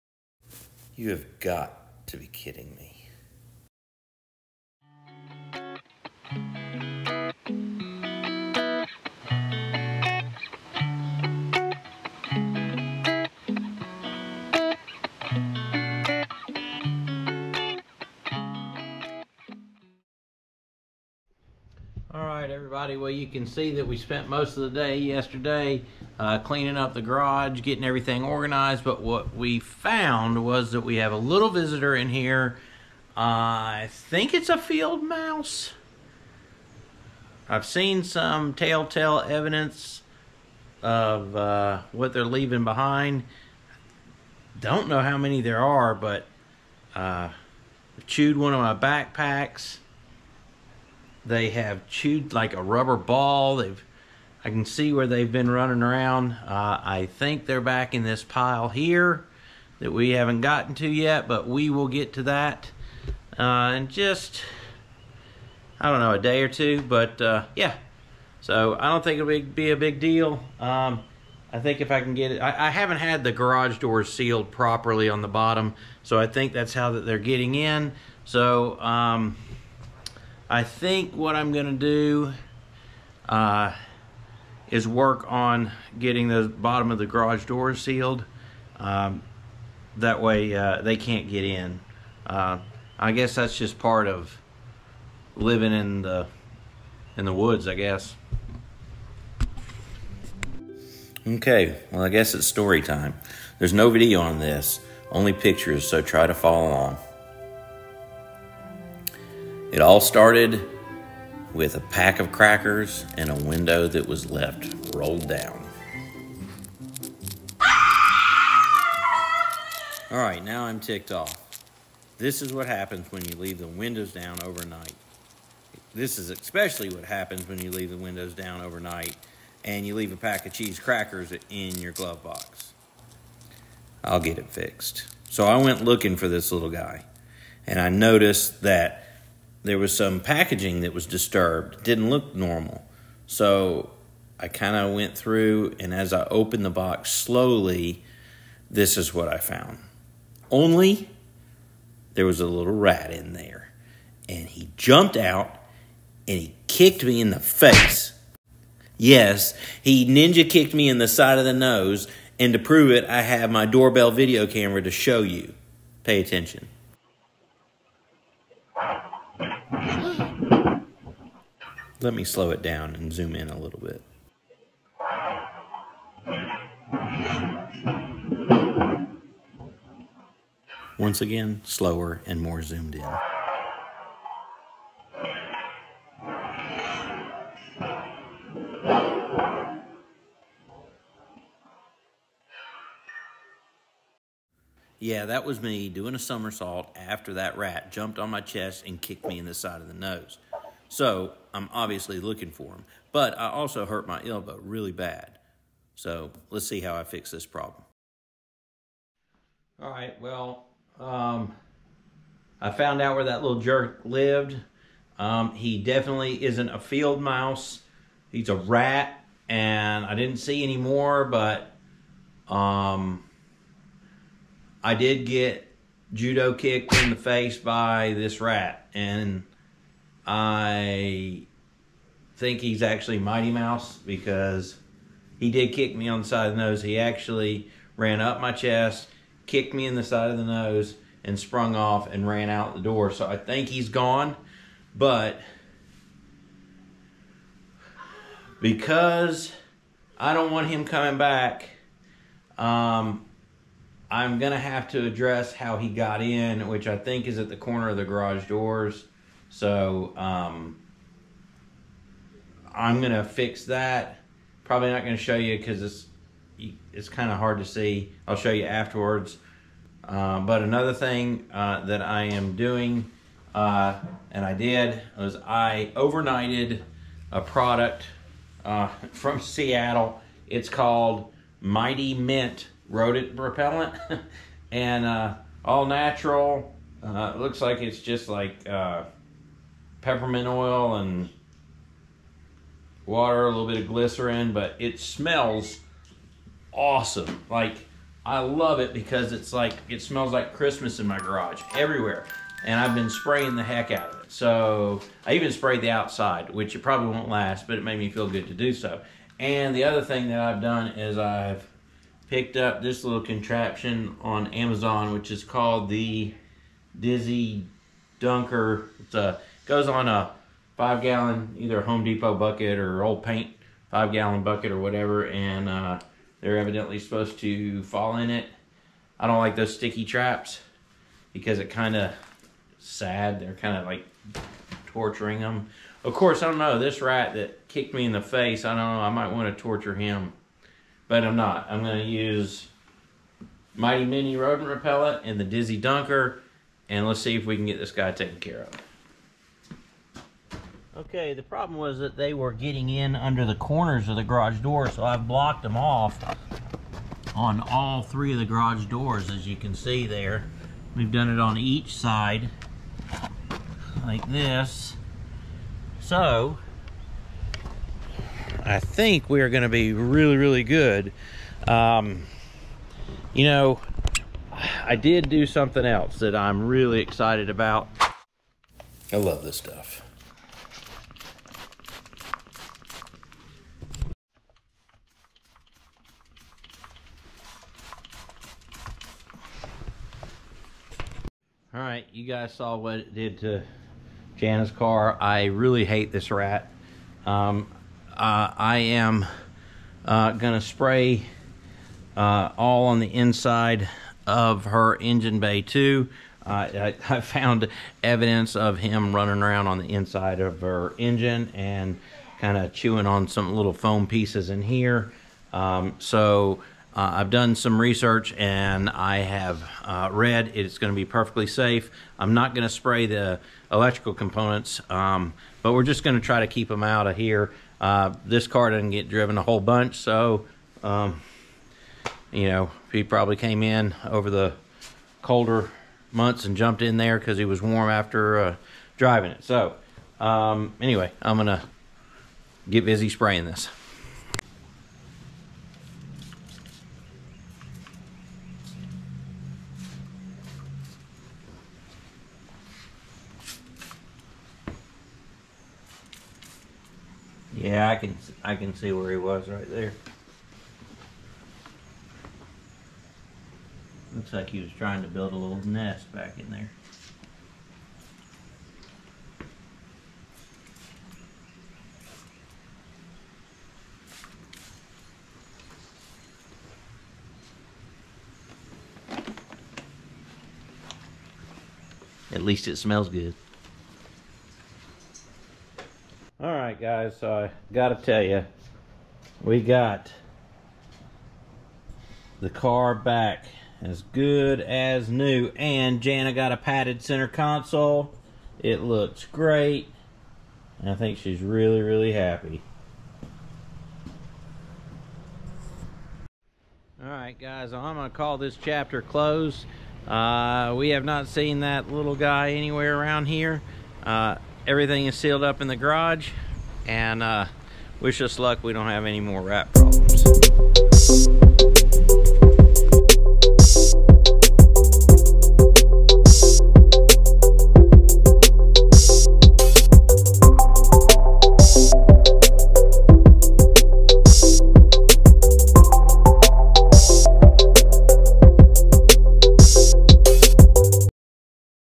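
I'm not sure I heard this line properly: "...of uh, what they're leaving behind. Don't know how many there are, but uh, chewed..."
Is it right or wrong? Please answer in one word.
right.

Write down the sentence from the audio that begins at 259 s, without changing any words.
So um, I'm gonna fix that.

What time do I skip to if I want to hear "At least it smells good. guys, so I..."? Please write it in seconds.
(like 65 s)
482 s.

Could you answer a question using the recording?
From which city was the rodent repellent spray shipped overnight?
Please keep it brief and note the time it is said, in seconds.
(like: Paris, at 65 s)
Seattle, at 279 s.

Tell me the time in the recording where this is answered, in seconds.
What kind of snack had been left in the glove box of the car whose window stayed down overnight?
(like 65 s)
130 s.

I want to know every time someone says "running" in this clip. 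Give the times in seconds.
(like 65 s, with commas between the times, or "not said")
55 s, 409 s.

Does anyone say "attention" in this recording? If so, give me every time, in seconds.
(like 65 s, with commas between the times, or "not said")
166 s.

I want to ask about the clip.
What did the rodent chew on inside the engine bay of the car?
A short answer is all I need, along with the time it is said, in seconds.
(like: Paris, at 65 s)
Foam pieces, at 413 s.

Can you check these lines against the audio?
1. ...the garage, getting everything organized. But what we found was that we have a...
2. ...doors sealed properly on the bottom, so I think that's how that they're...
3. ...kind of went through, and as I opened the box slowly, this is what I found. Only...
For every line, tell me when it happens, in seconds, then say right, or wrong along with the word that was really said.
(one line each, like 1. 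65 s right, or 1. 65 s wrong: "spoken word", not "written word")
1. 26 s right
2. 73 s right
3. 144 s right.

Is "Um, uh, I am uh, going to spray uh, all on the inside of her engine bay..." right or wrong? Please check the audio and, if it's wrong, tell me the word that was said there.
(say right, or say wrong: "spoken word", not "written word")
right.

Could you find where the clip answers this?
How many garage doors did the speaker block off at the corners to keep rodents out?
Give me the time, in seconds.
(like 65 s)
358 s.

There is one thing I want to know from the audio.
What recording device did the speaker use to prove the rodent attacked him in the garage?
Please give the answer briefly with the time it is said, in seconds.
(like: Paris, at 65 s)
Doorbell video camera, at 163 s.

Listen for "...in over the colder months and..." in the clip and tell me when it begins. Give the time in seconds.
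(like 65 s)
433 s.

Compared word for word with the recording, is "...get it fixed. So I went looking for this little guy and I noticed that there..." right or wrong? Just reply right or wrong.
right.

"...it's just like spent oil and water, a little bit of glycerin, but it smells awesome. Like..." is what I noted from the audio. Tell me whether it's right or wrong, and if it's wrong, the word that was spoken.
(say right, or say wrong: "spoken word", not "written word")
wrong: "peppermint", not "spent".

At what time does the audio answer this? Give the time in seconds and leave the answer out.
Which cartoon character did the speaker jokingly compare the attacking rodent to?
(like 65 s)
233 s.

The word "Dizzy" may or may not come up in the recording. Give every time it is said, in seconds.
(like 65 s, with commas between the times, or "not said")
316 s, 345 s.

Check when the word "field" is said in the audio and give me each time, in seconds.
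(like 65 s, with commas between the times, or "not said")
34 s, 216 s.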